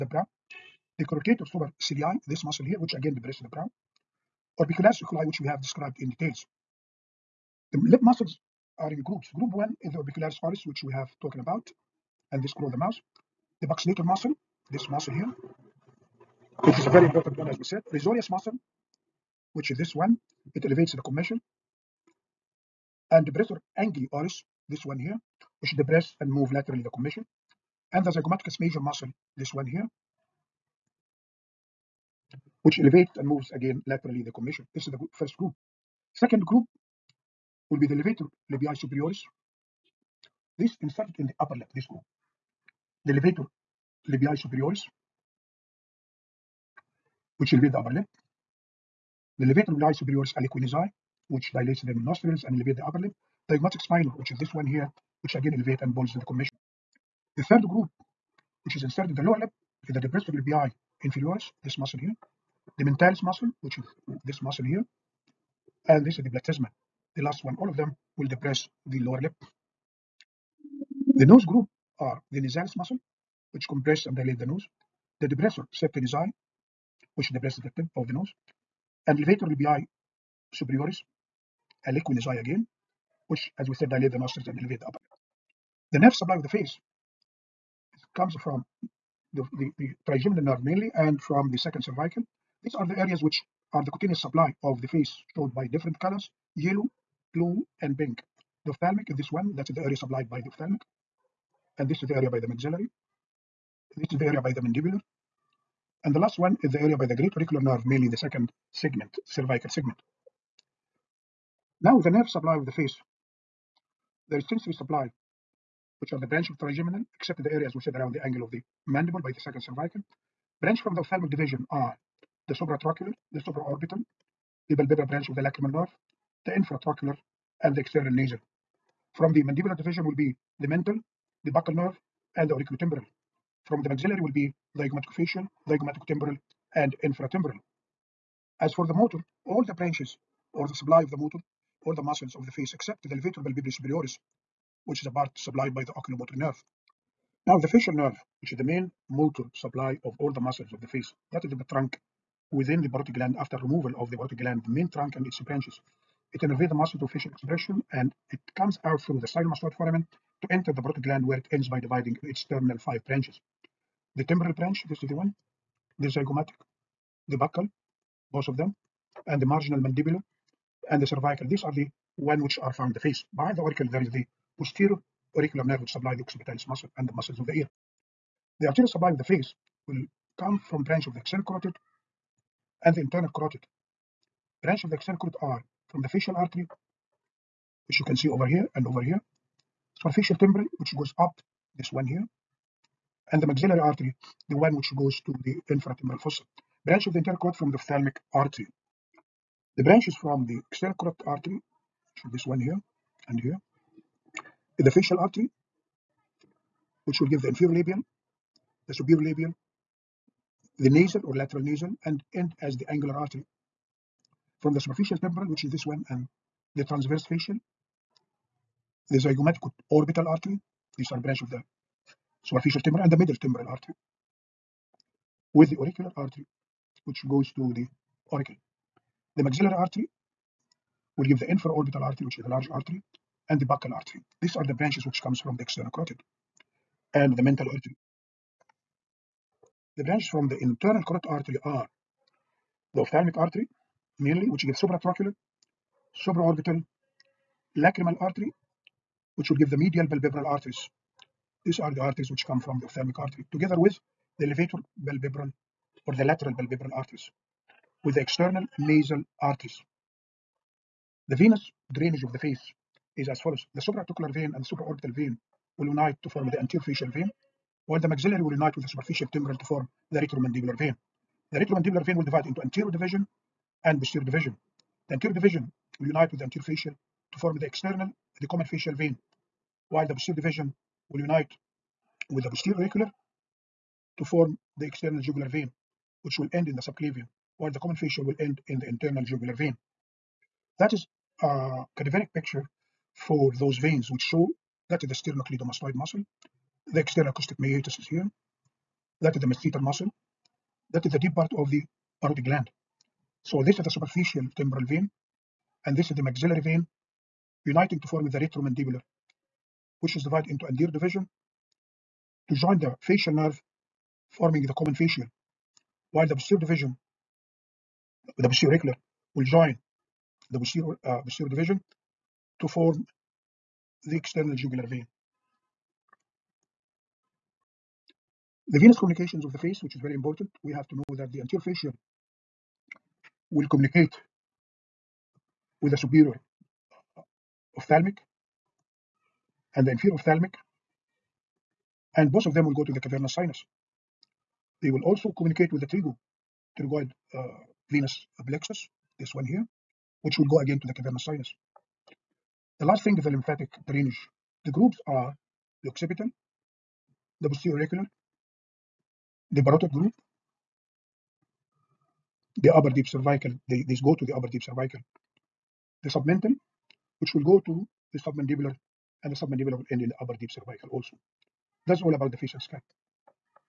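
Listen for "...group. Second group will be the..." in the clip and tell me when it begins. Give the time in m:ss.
0:35.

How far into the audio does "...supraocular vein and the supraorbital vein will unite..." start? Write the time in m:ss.
4:23.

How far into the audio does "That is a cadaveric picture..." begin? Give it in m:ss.
4:50.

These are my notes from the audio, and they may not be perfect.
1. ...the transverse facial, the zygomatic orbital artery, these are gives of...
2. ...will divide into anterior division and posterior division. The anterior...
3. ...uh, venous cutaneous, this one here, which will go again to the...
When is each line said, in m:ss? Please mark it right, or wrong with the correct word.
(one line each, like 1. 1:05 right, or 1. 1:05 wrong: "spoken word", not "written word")
1. 3:36 wrong: "branches", not "gives"
2. 4:32 right
3. 5:47 wrong: "plexus", not "cutaneous".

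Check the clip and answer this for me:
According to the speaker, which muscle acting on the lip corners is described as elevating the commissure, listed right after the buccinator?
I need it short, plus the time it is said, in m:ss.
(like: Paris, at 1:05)
Risorius, at 0:17.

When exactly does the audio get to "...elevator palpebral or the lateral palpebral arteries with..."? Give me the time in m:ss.
4:14.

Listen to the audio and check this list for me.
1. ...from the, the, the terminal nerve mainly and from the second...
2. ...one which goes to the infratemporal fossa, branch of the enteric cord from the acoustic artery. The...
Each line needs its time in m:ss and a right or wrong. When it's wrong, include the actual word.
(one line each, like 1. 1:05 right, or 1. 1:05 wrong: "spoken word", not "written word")
1. 1:28 wrong: "trigeminal", not "terminal"
2. 3:14 wrong: "ophthalmic", not "acoustic".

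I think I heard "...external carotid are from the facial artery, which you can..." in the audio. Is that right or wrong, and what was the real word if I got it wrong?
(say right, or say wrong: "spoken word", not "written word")
right.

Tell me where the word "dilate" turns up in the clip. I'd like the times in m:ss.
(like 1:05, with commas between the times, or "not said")
0:51, 1:14, 1:23.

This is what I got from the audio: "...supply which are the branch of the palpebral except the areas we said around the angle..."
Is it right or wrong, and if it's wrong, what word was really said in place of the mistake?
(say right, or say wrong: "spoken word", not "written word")
wrong: "trigeminal", not "palpebral".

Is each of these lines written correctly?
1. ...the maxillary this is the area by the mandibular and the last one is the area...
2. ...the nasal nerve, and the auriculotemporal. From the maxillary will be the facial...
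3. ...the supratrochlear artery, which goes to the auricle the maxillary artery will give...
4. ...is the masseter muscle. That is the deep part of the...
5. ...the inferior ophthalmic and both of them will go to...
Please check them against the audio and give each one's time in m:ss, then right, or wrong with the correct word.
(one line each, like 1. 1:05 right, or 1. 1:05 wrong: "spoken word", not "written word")
1. 1:42 right
2. 2:11 wrong: "buccal", not "nasal"
3. 3:45 wrong: "auricular", not "supratrochlear"
4. 4:59 right
5. 5:39 right.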